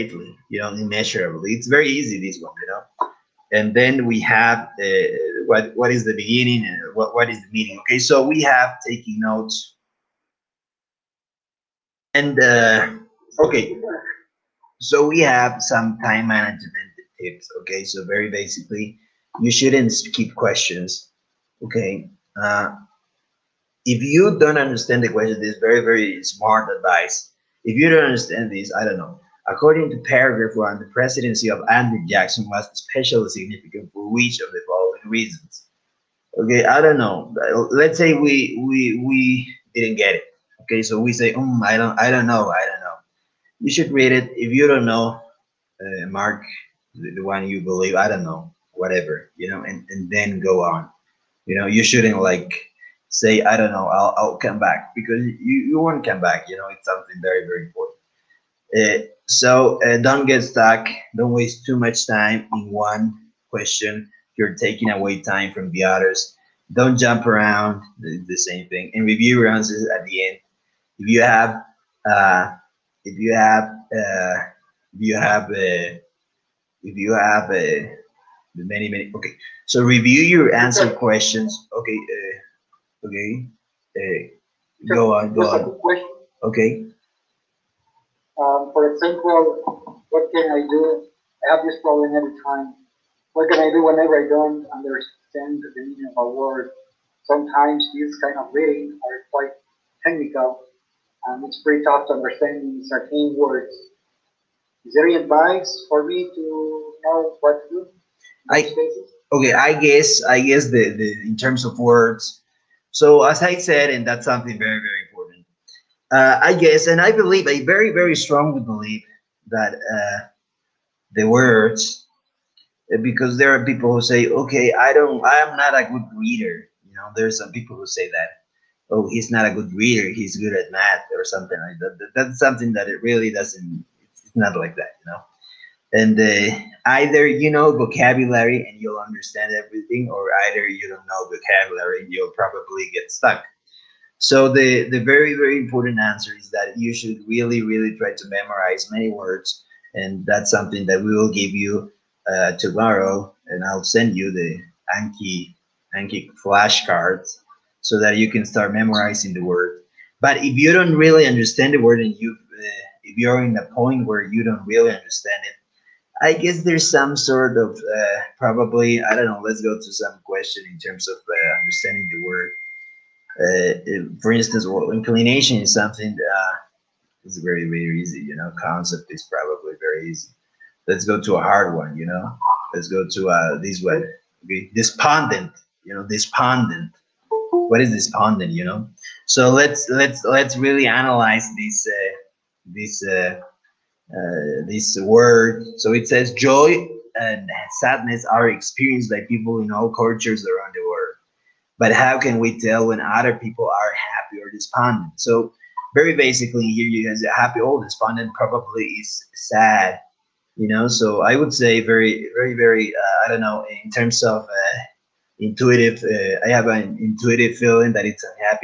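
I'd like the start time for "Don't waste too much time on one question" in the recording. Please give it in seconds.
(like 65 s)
61 s.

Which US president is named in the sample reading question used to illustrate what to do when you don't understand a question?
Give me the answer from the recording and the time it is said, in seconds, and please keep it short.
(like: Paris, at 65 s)
Andrew Jackson, at 31 s.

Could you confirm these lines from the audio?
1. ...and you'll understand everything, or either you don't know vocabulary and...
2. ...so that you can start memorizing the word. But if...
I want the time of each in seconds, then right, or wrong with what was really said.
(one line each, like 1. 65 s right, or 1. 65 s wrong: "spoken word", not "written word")
1. 138 s right
2. 157 s right.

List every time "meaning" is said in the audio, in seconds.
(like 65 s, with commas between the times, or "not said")
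7 s, 95 s.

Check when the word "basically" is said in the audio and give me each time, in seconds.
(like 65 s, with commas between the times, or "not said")
18 s, 206 s.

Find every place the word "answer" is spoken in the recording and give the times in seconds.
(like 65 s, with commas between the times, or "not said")
69 s, 80 s, 145 s.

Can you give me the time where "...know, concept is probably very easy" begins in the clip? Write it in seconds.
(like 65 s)
178 s.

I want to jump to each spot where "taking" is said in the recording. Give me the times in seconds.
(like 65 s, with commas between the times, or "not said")
8 s, 64 s.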